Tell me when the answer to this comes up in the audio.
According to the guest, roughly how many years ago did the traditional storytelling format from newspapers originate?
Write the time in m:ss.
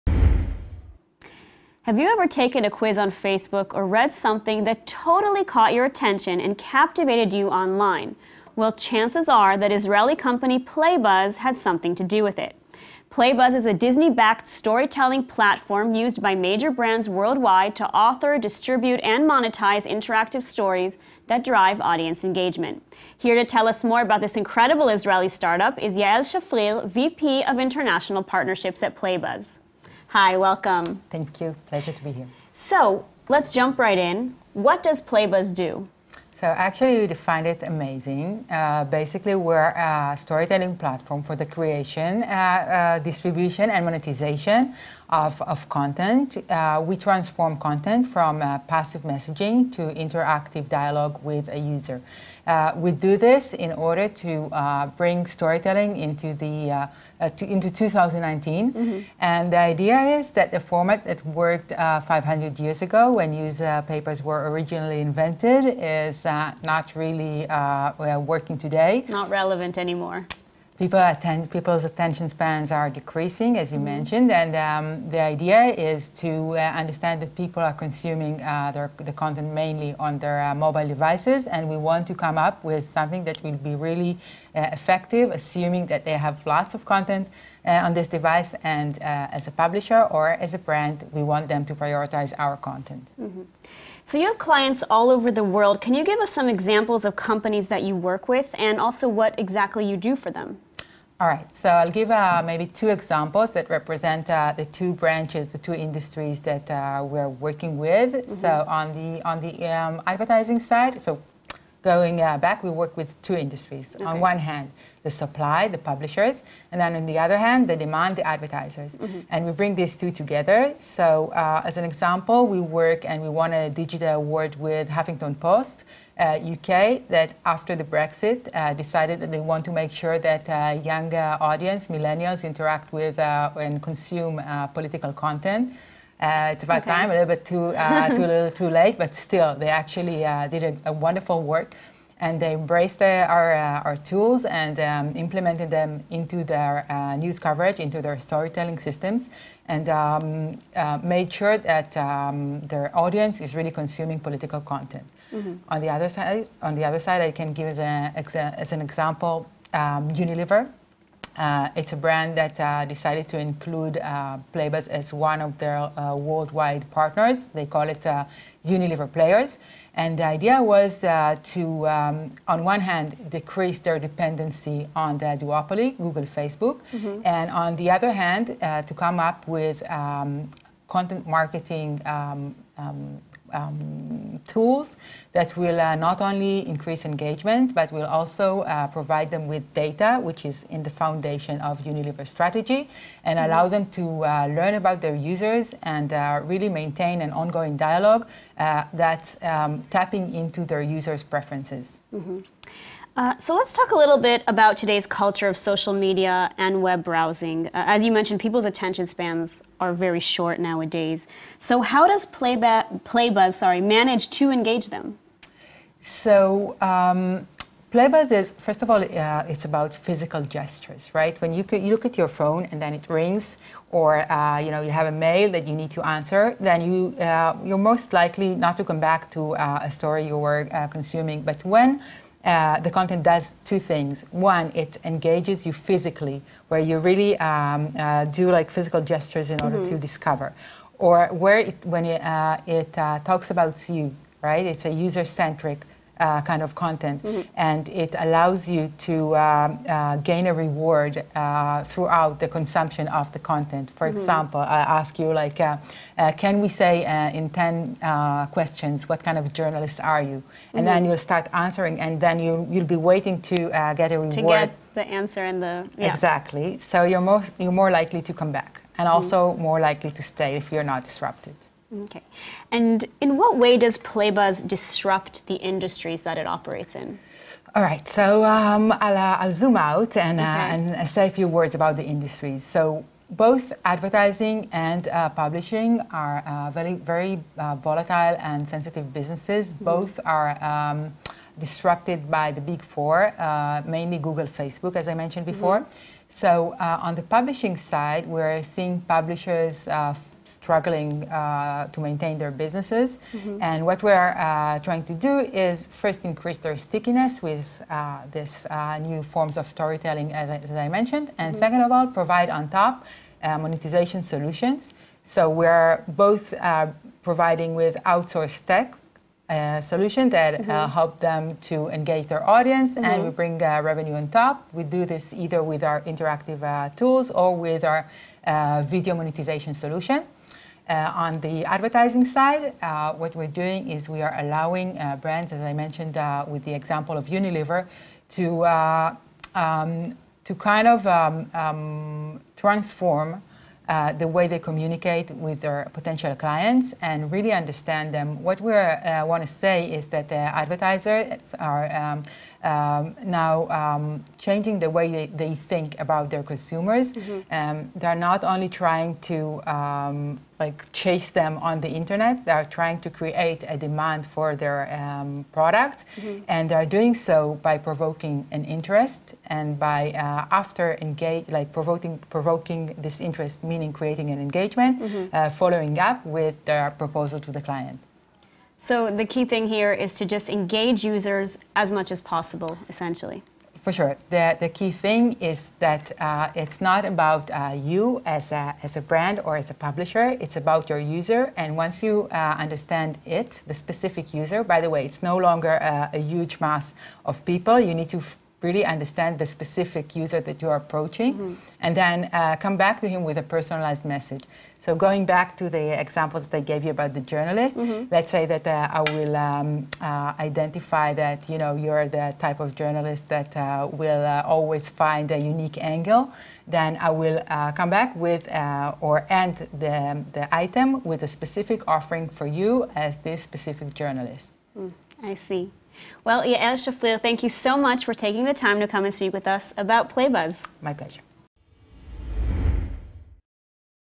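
1:01.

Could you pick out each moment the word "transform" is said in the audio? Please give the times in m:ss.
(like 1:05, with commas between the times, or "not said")
0:46, 5:42.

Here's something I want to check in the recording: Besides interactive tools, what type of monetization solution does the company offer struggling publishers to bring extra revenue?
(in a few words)
video monetization solution.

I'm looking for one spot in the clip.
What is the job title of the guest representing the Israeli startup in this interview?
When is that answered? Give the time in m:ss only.
0:26.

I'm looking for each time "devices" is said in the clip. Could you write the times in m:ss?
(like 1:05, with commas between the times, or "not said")
1:20, 1:28.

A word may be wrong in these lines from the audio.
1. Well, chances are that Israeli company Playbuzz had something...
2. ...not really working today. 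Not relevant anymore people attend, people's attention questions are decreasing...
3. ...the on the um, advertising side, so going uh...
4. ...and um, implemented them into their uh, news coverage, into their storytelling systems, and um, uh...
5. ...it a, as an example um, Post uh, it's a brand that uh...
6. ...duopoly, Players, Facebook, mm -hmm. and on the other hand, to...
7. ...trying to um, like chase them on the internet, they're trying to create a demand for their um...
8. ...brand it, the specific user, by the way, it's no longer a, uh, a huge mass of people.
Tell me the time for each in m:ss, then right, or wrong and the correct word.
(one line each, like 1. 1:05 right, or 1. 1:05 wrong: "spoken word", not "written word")
1. 0:08 right
2. 1:06 wrong: "spans", not "questions"
3. 1:48 right
4. 2:24 right
5. 2:37 wrong: "Unilever", not "Post"
6. 2:55 wrong: "Google", not "Players"
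7. 5:58 right
8. 6:32 wrong: "understand", not "brand".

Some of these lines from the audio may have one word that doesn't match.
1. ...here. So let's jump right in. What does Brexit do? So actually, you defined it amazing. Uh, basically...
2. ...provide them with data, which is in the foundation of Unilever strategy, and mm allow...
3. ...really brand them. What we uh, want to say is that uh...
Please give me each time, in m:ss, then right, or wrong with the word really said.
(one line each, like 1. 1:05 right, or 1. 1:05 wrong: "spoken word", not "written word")
1. 0:32 wrong: "PlayBuzz", not "Brexit"
2. 3:08 right
3. 5:47 wrong: "understand", not "brand".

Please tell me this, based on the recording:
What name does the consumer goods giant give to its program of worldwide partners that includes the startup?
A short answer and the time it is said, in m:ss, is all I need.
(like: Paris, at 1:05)
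Unilever Players, at 2:48.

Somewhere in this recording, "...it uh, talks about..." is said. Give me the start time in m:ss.
4:02.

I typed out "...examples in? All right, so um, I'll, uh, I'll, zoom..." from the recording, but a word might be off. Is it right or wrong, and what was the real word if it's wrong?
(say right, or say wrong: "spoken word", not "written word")
wrong: "operates", not "examples".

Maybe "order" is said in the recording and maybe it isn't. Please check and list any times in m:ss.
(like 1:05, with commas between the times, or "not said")
0:53, 3:59.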